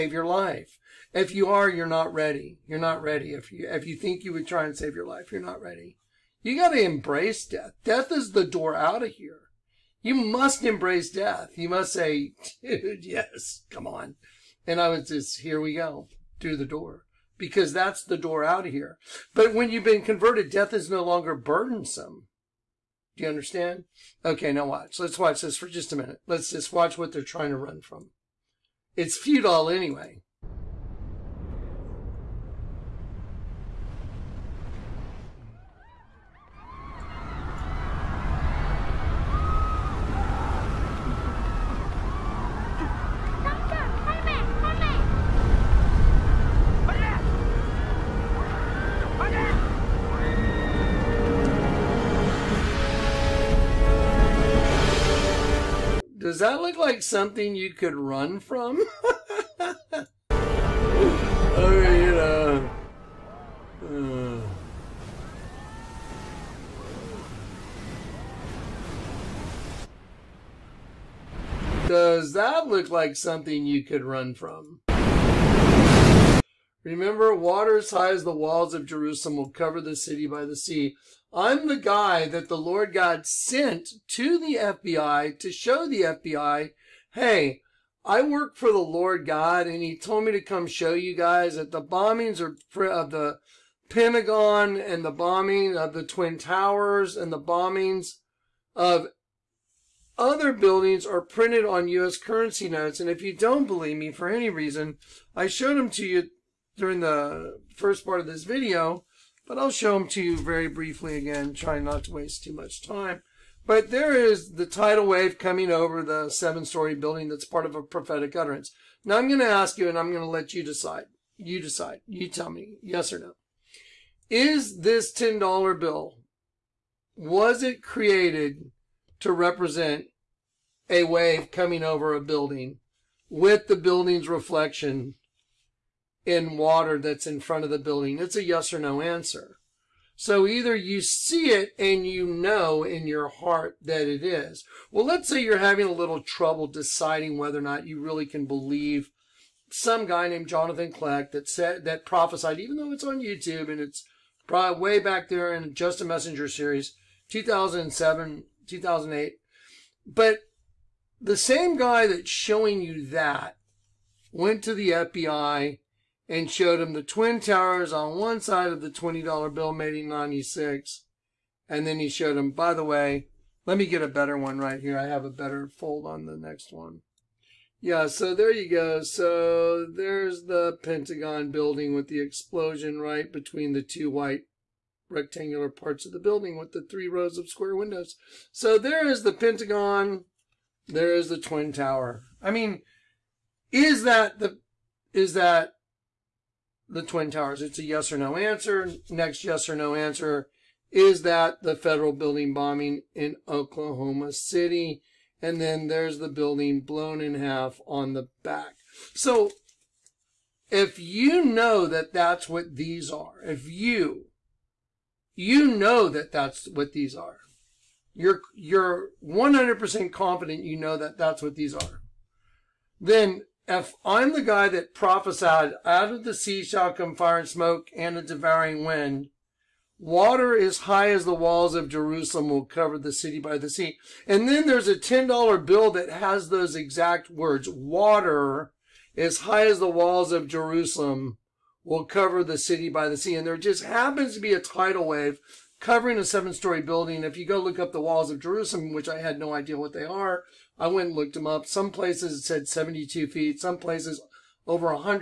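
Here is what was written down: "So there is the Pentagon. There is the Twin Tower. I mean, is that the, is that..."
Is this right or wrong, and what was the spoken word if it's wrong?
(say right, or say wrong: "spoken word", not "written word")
right.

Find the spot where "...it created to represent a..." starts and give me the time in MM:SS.
02:07.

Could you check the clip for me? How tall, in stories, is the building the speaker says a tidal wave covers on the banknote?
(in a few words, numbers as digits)
7.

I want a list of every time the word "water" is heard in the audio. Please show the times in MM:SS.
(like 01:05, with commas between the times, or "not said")
01:17, 02:16, 03:49, 03:57.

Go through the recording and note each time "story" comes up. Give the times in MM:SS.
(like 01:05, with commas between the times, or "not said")
01:56, 04:06.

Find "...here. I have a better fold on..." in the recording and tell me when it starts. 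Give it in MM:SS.
02:54.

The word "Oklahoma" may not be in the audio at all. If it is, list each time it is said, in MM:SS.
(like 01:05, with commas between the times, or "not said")
03:23.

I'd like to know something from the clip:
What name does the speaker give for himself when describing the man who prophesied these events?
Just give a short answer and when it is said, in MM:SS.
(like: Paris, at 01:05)
Jonathan Kleck, at 02:30.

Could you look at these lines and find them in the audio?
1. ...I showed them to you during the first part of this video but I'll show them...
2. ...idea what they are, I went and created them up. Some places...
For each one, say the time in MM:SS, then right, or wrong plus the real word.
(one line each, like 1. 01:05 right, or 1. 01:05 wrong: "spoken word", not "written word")
1. 01:45 right
2. 04:09 wrong: "looked", not "created".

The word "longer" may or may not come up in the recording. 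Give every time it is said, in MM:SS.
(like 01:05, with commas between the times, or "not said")
00:21.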